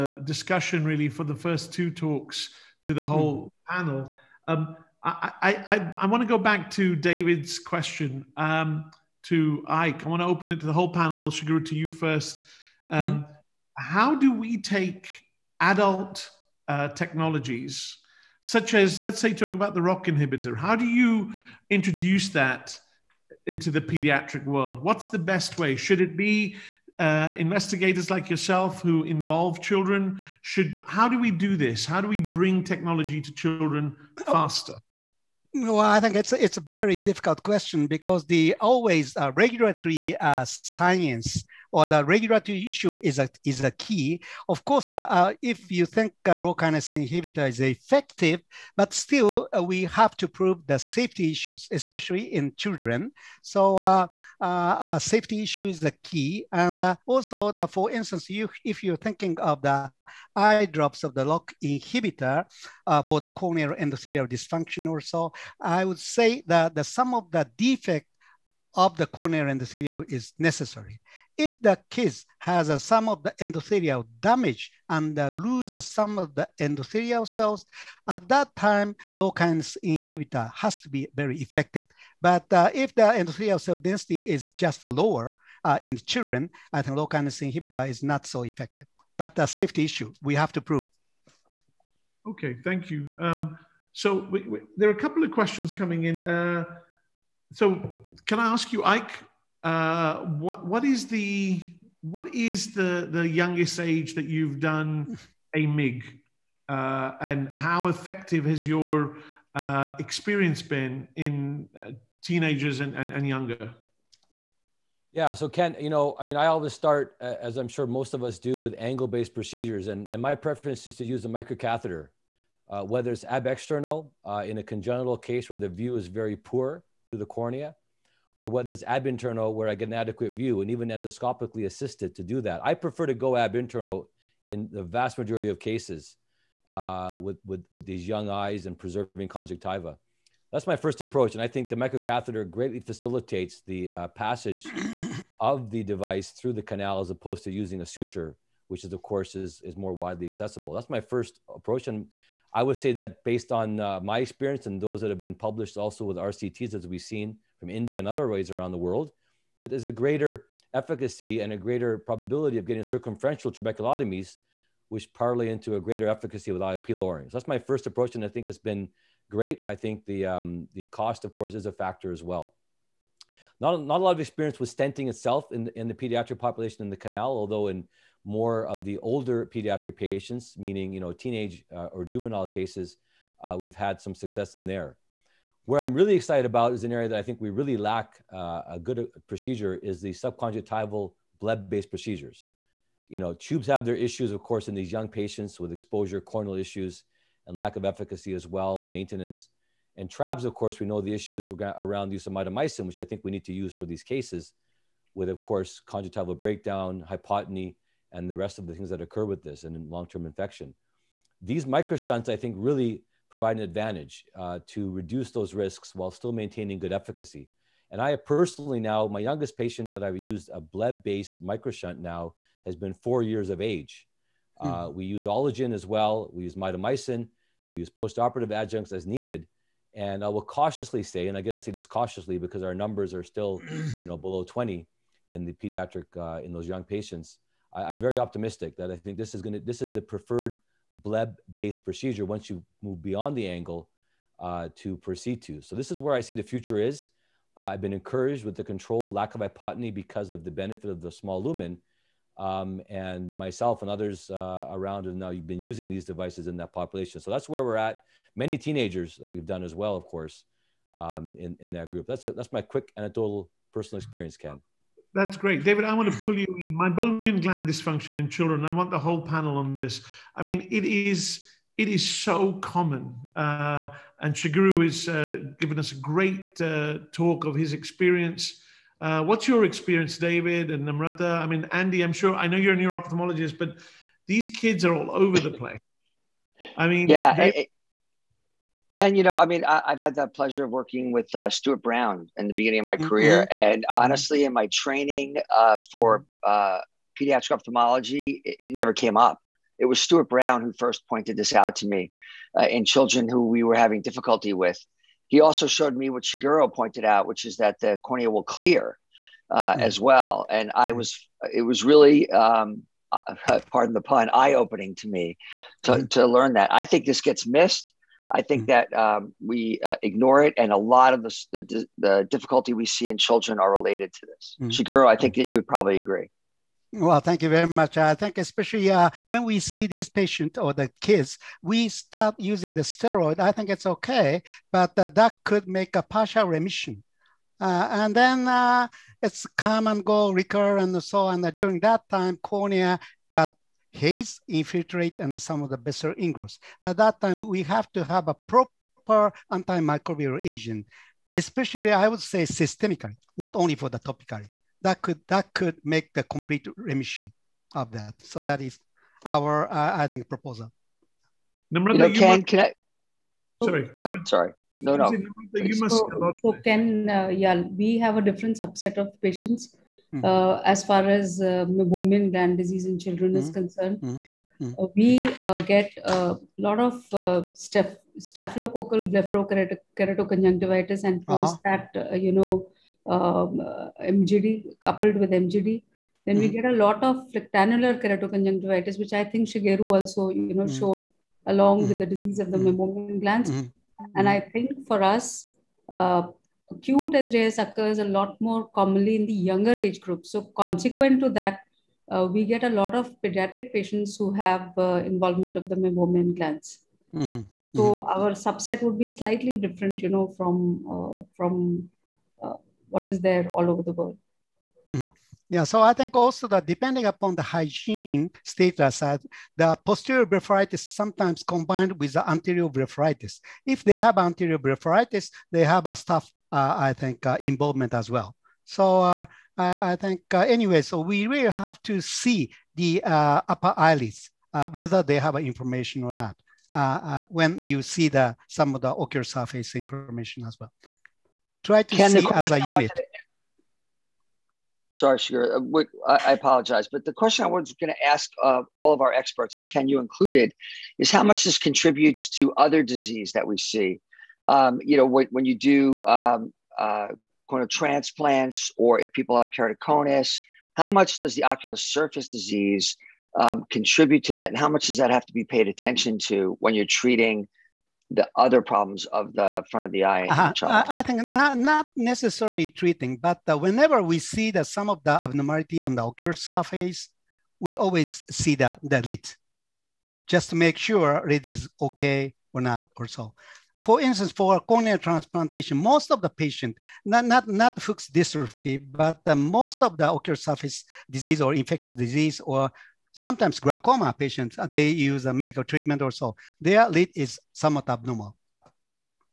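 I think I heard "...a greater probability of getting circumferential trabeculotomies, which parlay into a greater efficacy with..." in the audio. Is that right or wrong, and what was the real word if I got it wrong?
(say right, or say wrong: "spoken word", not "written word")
right.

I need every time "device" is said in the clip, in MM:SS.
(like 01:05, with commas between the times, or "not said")
02:25, 04:16.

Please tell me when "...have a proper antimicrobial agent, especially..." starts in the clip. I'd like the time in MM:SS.
05:48.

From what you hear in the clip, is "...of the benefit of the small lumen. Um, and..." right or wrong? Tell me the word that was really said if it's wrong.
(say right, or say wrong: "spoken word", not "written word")
right.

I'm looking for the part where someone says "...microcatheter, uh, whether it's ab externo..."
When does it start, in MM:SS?
02:01.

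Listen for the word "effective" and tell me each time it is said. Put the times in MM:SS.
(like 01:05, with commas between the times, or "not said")
00:47, 01:21, 01:28, 01:47.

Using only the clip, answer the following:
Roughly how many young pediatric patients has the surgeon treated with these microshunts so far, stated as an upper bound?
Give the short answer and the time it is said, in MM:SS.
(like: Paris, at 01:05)
Below 20, at 03:54.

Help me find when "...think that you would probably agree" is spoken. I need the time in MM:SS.
05:25.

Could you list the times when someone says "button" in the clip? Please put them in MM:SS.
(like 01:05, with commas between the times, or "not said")
not said.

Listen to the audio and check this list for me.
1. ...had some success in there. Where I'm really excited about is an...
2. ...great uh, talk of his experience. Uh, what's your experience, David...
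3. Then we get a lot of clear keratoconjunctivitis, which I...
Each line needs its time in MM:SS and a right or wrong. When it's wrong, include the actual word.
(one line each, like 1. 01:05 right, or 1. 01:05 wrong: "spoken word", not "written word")
1. 03:03 right
2. 04:35 right
3. 06:26 wrong: "phlyctenular", not "clear".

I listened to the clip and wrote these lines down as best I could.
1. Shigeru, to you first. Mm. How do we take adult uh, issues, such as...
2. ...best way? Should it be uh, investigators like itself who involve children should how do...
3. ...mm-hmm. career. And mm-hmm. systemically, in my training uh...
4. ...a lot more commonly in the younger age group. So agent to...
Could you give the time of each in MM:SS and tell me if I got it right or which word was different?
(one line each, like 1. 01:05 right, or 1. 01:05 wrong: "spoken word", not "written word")
1. 00:11 wrong: "technologies", not "issues"
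2. 00:25 wrong: "yourself", not "itself"
3. 04:52 wrong: "honestly", not "systemically"
4. 06:37 wrong: "consequent", not "agent".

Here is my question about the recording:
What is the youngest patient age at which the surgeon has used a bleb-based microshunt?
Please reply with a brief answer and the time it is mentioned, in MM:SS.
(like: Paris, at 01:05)
4, at 03:42.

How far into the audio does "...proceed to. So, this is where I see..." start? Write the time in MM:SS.
04:04.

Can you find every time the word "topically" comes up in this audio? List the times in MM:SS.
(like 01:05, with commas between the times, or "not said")
05:53.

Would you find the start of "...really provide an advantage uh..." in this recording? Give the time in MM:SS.
03:32.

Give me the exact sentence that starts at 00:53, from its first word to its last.
So uh, uh, safety issue is the key.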